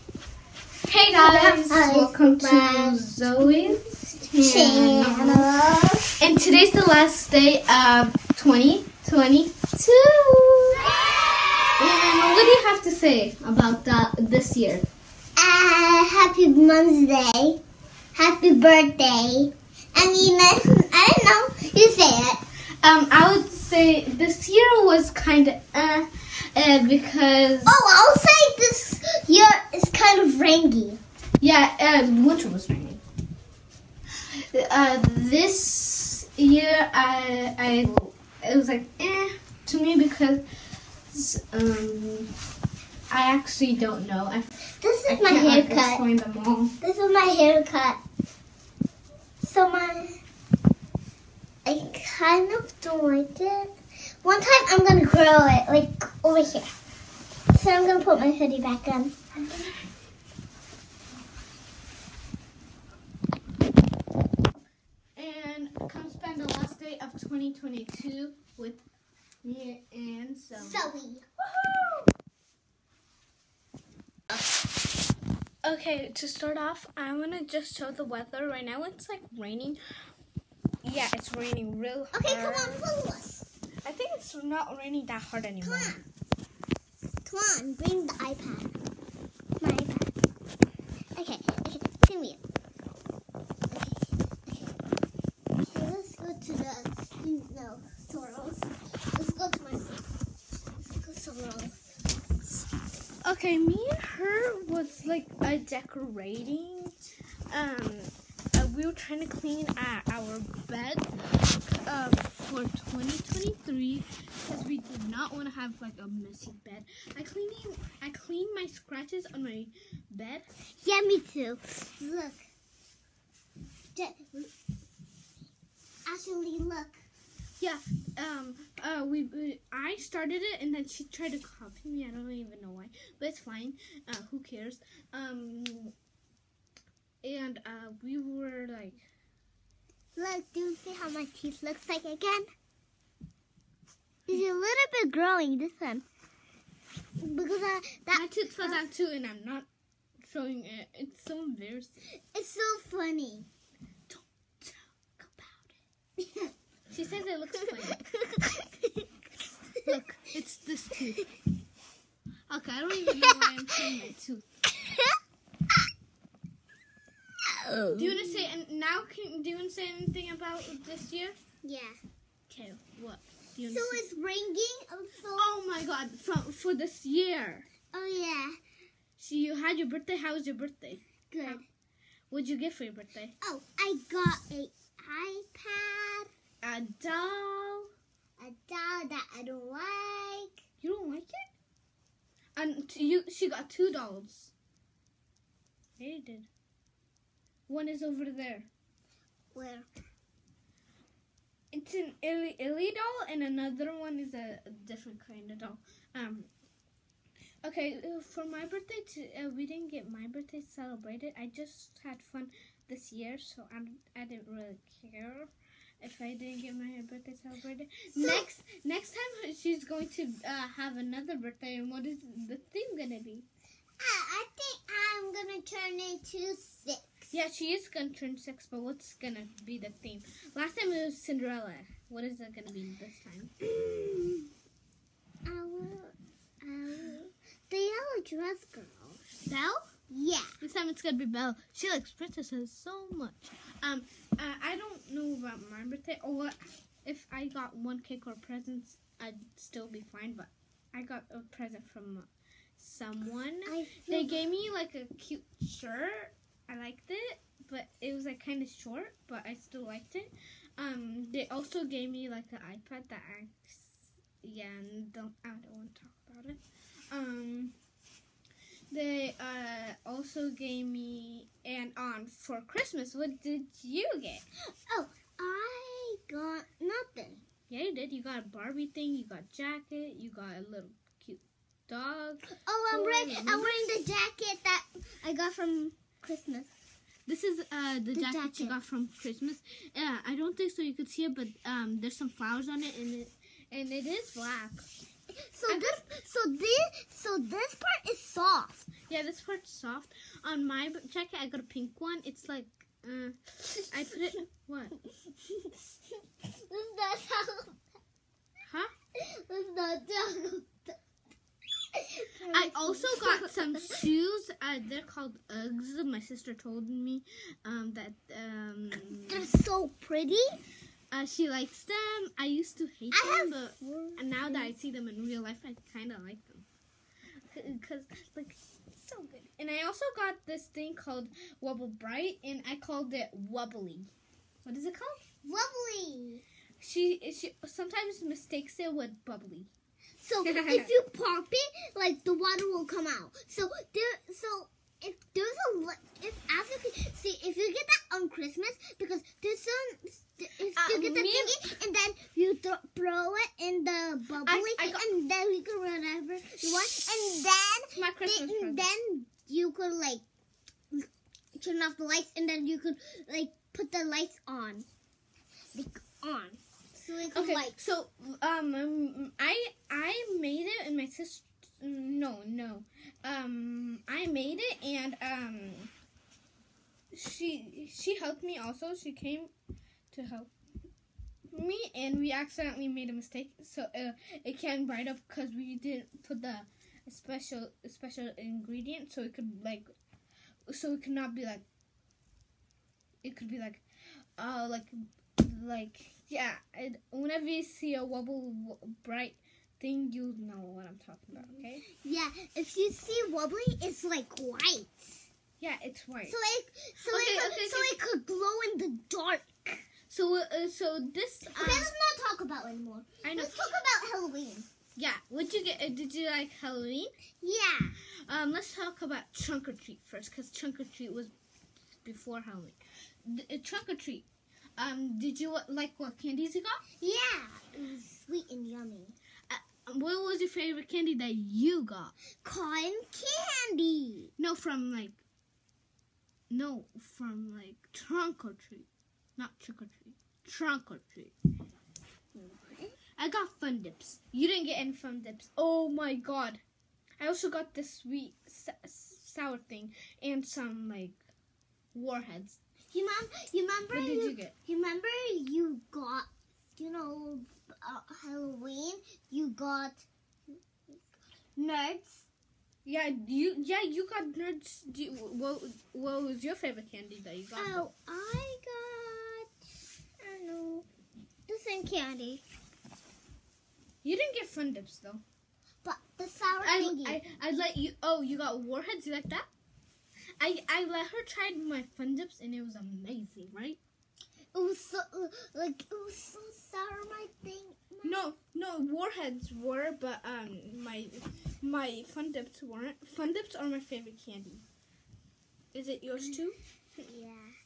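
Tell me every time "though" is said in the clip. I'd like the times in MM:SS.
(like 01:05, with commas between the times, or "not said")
07:54.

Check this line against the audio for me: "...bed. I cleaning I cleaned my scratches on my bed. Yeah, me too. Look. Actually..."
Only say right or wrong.
right.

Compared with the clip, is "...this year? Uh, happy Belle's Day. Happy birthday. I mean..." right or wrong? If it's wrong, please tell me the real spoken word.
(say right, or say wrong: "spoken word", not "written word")
wrong: "Mom", not "Belle".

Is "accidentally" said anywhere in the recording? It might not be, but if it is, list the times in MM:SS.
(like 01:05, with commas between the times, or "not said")
06:22.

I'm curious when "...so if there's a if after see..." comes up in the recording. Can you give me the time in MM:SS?
05:44.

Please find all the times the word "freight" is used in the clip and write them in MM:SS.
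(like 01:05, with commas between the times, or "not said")
not said.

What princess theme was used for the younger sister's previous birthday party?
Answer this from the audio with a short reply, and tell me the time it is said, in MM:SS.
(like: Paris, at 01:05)
Cinderella, at 03:51.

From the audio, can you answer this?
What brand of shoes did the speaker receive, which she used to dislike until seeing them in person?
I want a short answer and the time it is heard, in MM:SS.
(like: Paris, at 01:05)
Uggs, at 05:15.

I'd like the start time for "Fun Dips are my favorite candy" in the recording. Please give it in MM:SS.
08:13.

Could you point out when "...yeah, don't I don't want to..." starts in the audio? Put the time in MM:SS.
04:24.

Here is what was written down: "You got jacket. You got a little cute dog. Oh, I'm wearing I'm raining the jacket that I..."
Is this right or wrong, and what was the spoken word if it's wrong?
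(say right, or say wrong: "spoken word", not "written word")
wrong: "wearing", not "raining".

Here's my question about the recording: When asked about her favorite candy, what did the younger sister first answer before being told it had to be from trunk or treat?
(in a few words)
Cotton candy.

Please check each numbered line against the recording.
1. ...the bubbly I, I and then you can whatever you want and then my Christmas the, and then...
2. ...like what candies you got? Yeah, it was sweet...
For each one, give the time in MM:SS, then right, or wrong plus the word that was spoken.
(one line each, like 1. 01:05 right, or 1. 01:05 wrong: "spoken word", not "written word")
1. 05:53 right
2. 07:05 right.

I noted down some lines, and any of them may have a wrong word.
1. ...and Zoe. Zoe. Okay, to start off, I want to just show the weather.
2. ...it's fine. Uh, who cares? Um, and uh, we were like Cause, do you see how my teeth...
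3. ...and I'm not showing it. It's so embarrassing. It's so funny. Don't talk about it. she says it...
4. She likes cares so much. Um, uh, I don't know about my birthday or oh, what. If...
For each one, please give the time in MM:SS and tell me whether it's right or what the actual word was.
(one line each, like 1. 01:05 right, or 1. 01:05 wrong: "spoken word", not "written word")
1. 01:09 right
2. 02:13 wrong: "Look", not "Cause"
3. 02:29 right
4. 04:01 wrong: "princesses", not "cares".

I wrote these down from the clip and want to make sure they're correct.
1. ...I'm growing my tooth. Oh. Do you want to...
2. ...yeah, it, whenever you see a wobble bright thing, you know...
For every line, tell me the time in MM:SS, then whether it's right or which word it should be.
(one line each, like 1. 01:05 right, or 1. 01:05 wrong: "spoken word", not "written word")
1. 02:43 wrong: "showing", not "growing"
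2. 06:36 right.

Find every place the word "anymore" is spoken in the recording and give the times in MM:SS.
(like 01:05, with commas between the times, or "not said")
01:25, 06:52.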